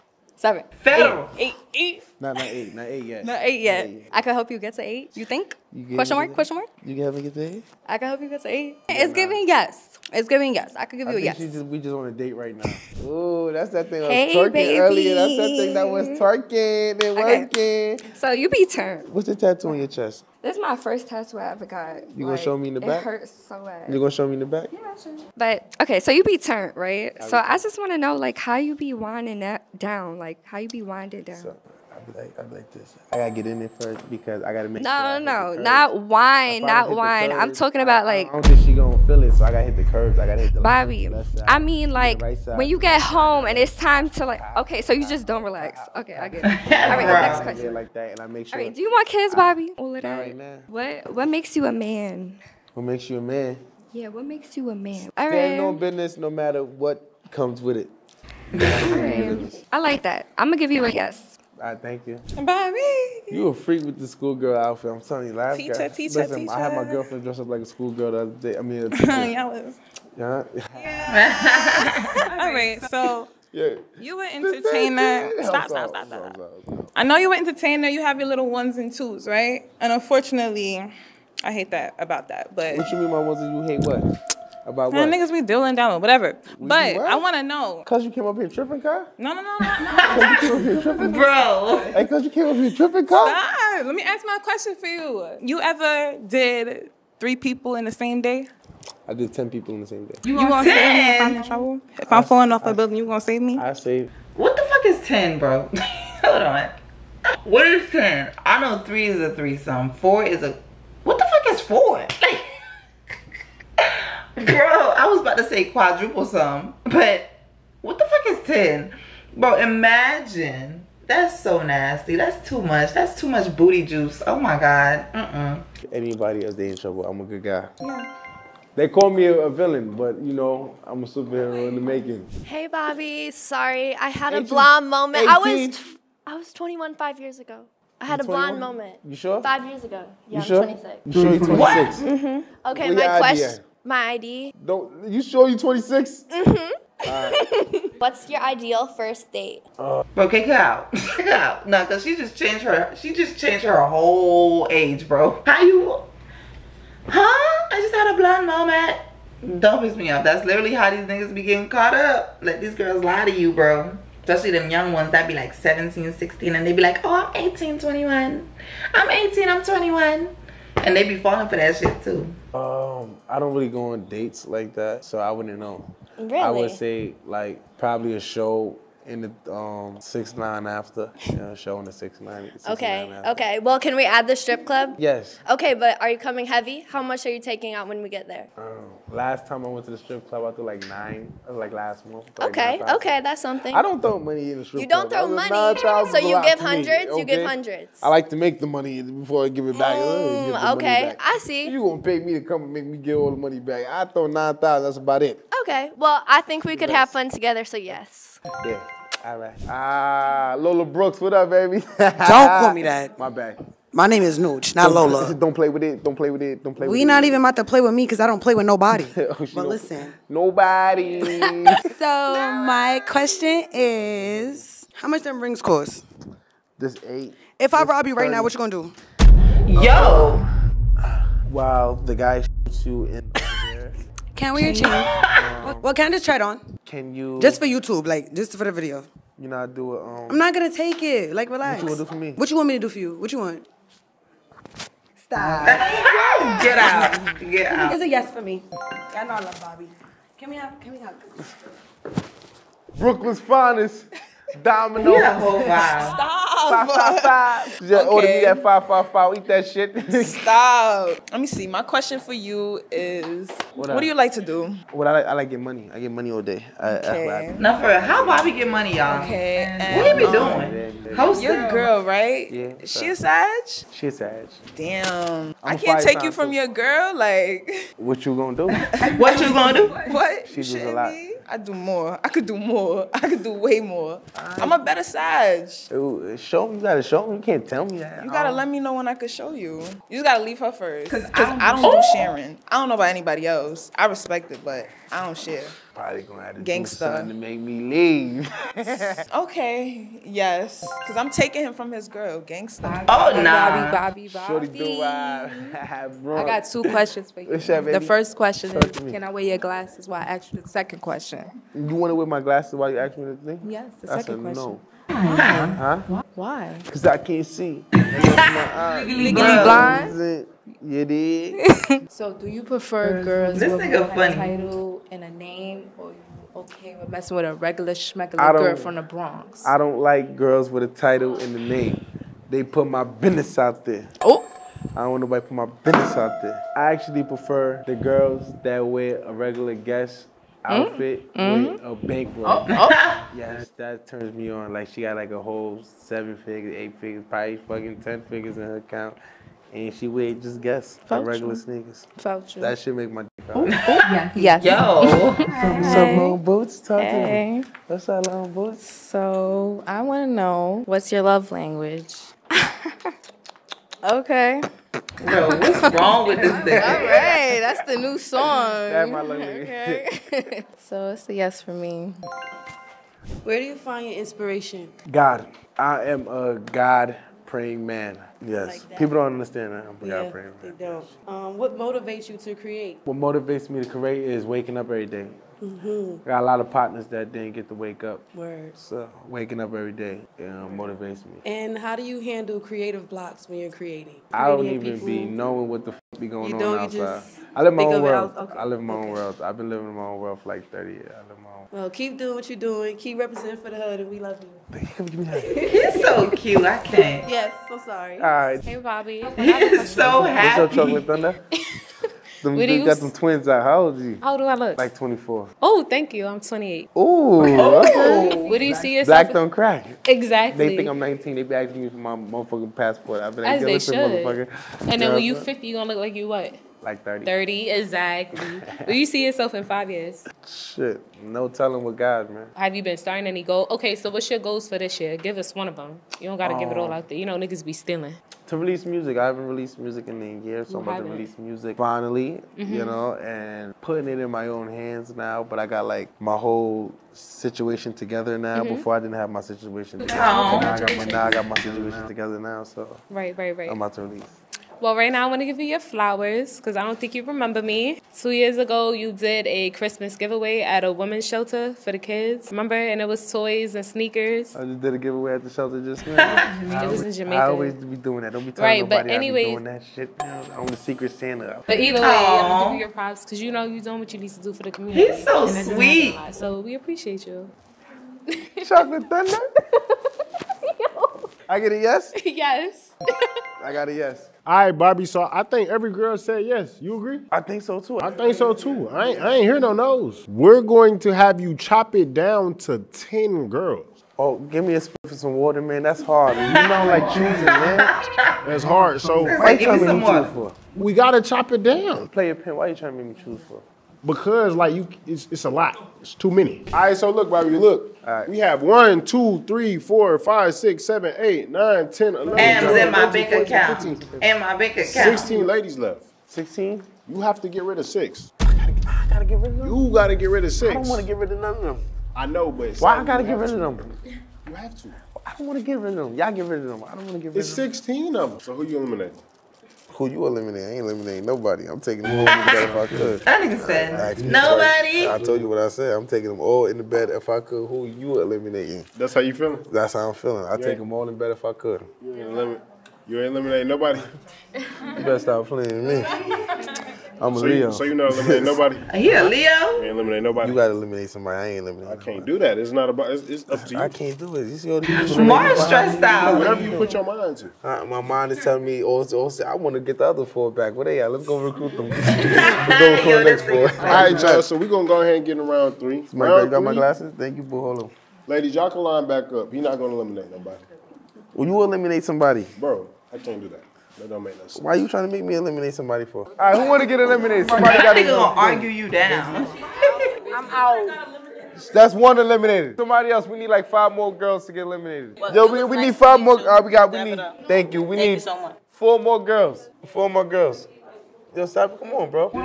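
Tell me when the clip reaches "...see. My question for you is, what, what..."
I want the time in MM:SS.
04:21.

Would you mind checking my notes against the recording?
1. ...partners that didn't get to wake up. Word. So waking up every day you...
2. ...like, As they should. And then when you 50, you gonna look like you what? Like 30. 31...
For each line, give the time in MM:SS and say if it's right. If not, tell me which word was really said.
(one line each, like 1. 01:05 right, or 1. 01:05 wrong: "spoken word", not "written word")
1. 06:26 right
2. 07:03 wrong: "30", not "31".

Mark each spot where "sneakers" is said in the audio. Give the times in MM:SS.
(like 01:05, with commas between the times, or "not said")
05:51, 07:43.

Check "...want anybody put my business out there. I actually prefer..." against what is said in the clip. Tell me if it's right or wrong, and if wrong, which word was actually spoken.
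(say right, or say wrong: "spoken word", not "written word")
wrong: "nobody", not "anybody".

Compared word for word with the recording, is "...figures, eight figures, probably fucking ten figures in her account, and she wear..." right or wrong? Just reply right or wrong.
right.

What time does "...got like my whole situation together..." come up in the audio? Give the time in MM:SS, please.
07:25.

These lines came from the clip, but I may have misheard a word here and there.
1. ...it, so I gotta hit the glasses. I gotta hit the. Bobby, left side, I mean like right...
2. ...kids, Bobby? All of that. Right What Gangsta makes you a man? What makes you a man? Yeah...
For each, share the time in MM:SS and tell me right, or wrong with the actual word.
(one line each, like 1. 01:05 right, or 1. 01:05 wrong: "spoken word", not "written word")
1. 00:39 wrong: "curves", not "glasses"
2. 00:49 wrong: "What", not "Gangsta".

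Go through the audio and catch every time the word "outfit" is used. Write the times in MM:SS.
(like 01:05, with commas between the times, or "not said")
01:04, 05:40.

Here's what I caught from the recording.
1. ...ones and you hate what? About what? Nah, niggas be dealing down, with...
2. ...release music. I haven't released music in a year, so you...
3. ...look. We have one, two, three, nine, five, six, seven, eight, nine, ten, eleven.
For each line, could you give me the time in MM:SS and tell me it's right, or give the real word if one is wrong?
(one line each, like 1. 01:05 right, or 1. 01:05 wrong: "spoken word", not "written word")
1. 01:23 right
2. 07:18 right
3. 08:27 wrong: "four", not "nine".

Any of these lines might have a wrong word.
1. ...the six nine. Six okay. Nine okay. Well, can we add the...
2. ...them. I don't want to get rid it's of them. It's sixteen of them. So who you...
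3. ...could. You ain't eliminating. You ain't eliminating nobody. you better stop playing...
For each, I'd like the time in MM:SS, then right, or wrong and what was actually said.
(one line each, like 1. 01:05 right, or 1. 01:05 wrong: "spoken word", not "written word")
1. 03:01 right
2. 08:46 right
3. 09:01 right.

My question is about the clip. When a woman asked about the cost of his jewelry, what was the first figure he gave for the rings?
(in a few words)
8.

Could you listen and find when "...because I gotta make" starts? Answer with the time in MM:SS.
00:34.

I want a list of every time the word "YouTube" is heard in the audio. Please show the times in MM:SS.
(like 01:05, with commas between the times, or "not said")
03:57.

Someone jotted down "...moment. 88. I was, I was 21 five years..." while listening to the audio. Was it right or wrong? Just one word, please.
wrong.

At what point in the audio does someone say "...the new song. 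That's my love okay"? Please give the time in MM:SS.
06:07.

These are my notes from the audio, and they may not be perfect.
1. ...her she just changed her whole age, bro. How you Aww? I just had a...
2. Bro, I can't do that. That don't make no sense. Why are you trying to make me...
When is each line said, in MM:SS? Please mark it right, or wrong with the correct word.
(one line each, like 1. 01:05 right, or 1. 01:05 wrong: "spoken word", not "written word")
1. 02:32 wrong: "Huh", not "Aww"
2. 09:32 right.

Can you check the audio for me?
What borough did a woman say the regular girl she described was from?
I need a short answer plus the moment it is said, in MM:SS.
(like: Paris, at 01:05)
The Bronx, at 05:29.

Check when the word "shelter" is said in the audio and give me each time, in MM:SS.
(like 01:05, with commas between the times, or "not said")
07:41, 07:45.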